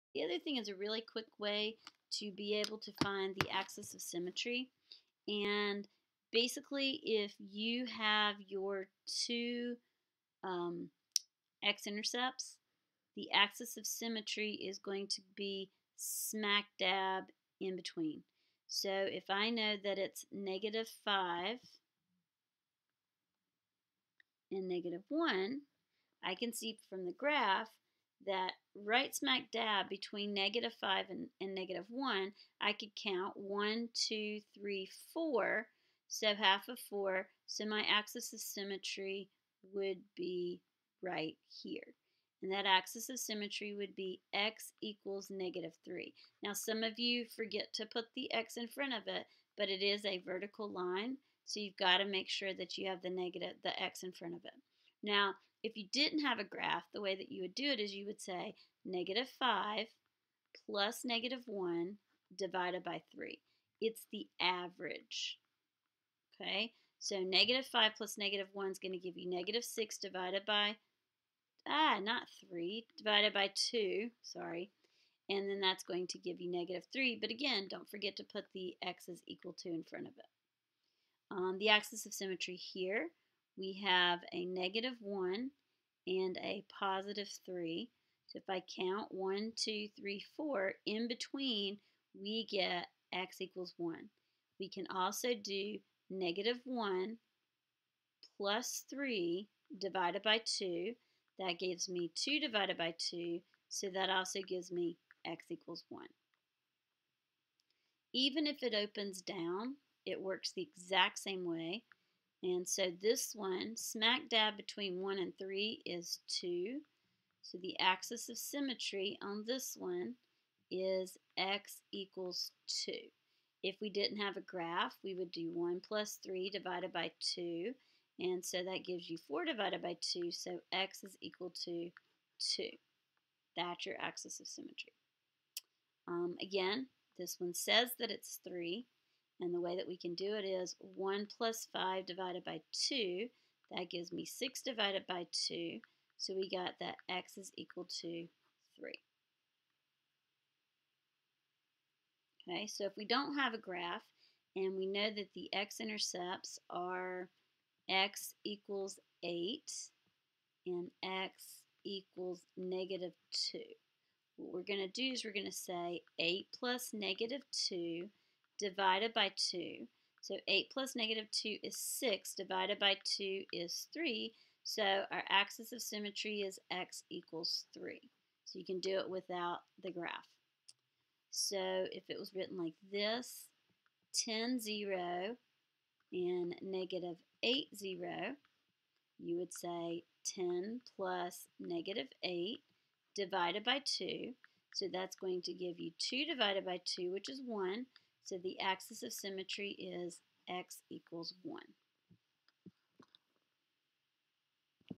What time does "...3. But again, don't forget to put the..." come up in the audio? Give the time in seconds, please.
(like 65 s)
76 s.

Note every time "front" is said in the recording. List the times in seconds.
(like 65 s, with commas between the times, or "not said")
48 s, 54 s, 79 s.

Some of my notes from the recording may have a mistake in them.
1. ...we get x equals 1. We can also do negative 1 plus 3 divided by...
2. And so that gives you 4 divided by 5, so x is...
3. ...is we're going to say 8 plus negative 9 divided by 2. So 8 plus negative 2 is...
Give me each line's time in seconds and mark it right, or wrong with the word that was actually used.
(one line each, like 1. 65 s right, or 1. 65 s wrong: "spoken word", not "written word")
1. 92 s right
2. 128 s wrong: "2", not "5"
3. 165 s wrong: "2", not "9".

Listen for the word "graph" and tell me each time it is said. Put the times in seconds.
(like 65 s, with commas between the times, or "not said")
27 s, 56 s, 124 s, 153 s, 179 s.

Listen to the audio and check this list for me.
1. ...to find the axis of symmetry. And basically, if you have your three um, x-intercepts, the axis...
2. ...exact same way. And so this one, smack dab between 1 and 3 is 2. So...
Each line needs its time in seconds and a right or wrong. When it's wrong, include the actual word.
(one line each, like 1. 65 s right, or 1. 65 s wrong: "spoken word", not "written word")
1. 2 s wrong: "two", not "three"
2. 110 s right.